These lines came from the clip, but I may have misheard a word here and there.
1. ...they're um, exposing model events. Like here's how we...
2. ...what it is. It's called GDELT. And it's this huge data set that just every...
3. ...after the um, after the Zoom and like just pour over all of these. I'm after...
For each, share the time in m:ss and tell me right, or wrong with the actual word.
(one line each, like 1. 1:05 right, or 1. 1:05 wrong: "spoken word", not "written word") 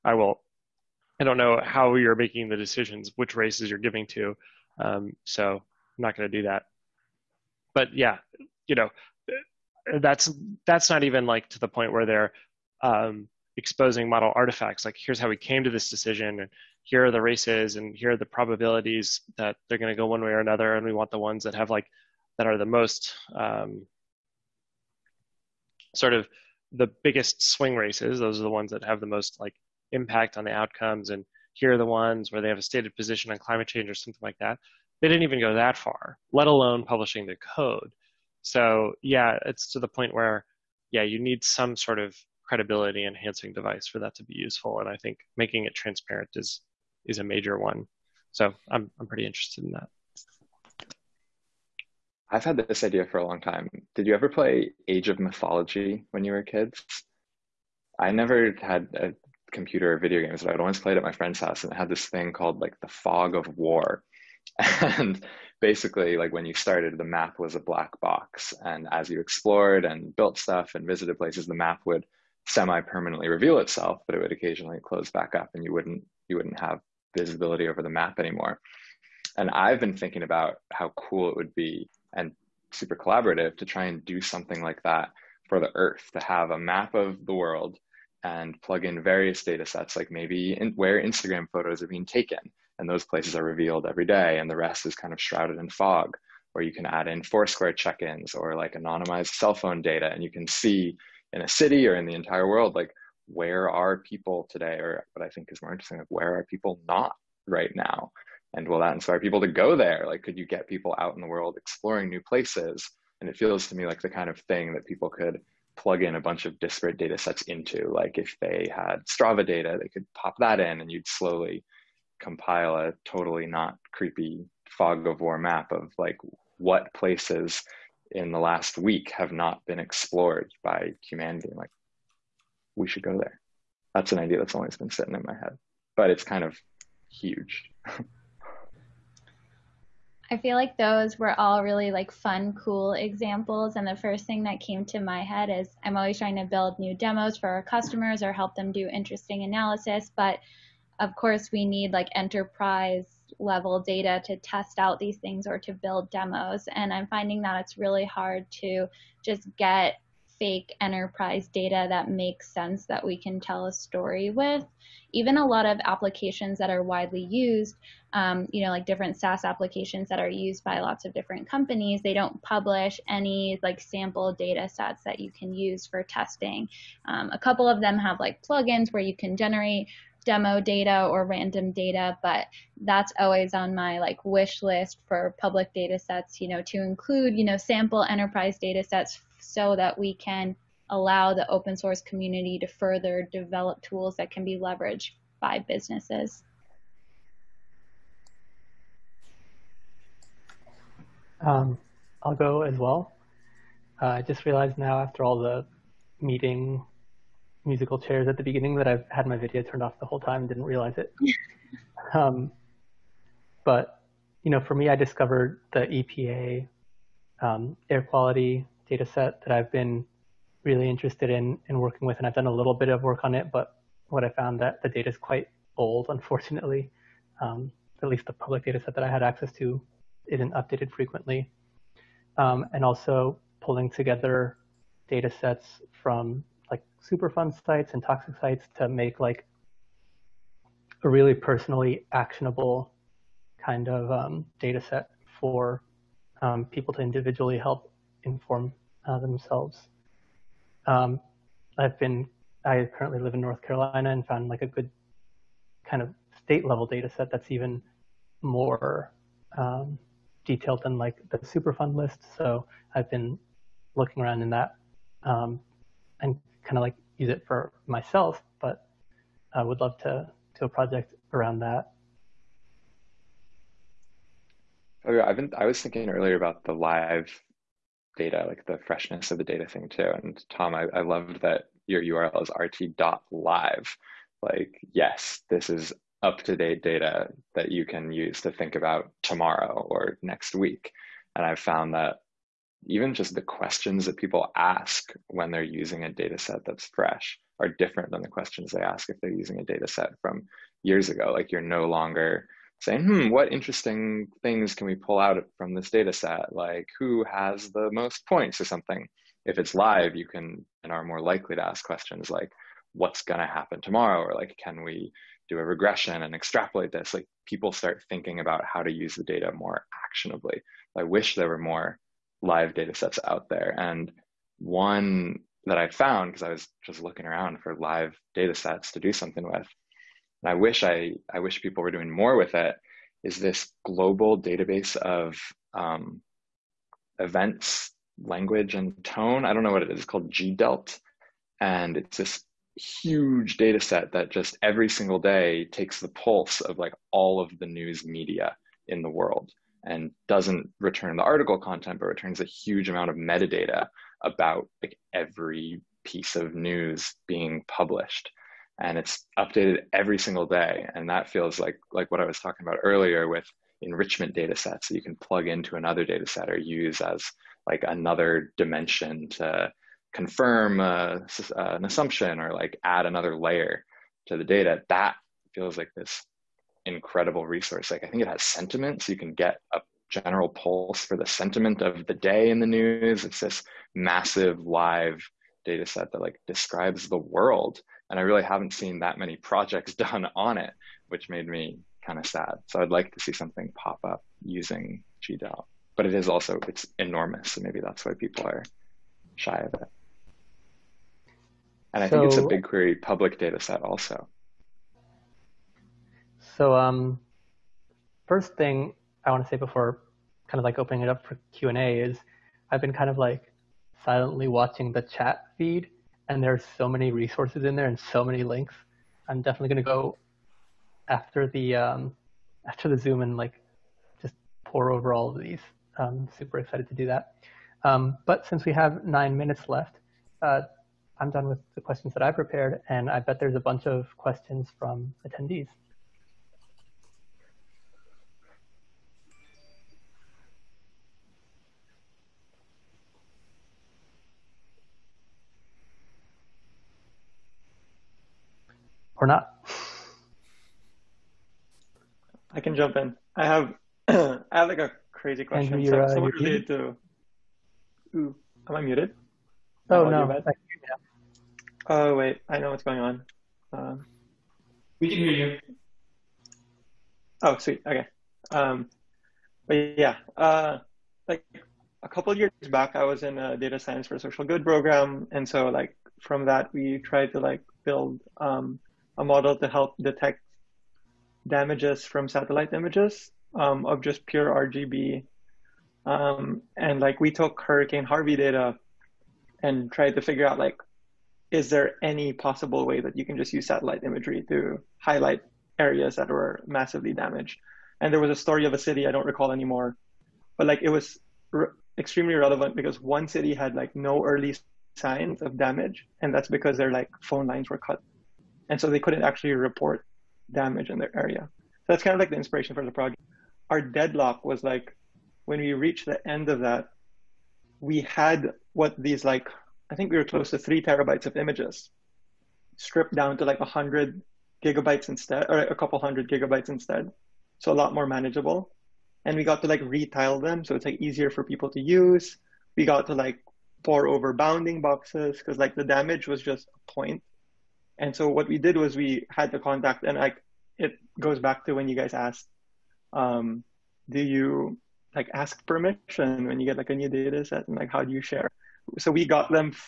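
1. 0:12 wrong: "artifacts", not "events"
2. 5:39 right
3. 7:01 wrong: "super", not "after".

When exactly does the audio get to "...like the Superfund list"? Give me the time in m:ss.
4:20.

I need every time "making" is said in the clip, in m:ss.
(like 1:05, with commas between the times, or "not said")
0:02, 0:45.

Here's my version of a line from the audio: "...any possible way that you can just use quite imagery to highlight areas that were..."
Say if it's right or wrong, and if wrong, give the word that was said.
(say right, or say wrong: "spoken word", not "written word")
wrong: "satellite", not "quite".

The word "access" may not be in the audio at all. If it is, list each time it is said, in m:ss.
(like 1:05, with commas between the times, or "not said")
3:49.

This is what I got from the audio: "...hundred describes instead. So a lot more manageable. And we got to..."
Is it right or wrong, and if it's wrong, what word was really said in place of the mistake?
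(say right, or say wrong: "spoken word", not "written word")
wrong: "gigabytes", not "describes".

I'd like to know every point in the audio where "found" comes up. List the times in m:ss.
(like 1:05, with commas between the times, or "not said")
3:44, 4:14, 4:51, 5:25.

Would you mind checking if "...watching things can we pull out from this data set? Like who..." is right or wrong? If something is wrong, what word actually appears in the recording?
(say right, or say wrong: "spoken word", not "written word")
wrong: "interesting", not "watching".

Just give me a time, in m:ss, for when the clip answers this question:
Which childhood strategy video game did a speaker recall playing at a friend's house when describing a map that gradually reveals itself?
0:54.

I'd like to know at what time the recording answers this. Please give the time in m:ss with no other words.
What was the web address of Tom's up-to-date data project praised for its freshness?
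4:42.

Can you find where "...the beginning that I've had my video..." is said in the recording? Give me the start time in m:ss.
3:28.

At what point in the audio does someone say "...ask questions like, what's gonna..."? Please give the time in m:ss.
5:11.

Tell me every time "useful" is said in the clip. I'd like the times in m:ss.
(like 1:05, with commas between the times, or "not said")
0:44.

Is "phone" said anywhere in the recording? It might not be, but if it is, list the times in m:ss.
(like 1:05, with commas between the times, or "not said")
1:39, 8:27.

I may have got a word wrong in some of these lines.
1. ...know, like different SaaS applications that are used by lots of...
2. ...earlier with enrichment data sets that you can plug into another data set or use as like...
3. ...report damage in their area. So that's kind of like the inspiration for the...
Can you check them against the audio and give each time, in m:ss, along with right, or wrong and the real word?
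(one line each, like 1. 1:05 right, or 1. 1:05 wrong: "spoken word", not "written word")
1. 2:48 right
2. 6:02 right
3. 8:29 right.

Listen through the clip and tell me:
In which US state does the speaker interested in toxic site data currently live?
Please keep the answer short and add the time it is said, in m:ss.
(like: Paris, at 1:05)
North Carolina, at 4:13.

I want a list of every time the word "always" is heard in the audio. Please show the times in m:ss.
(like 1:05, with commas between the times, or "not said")
2:14, 2:25, 3:03.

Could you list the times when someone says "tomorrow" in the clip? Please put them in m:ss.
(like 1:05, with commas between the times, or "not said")
4:49, 5:13.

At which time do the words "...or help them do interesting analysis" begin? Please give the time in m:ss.
2:28.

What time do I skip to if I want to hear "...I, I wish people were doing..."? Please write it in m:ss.
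5:30.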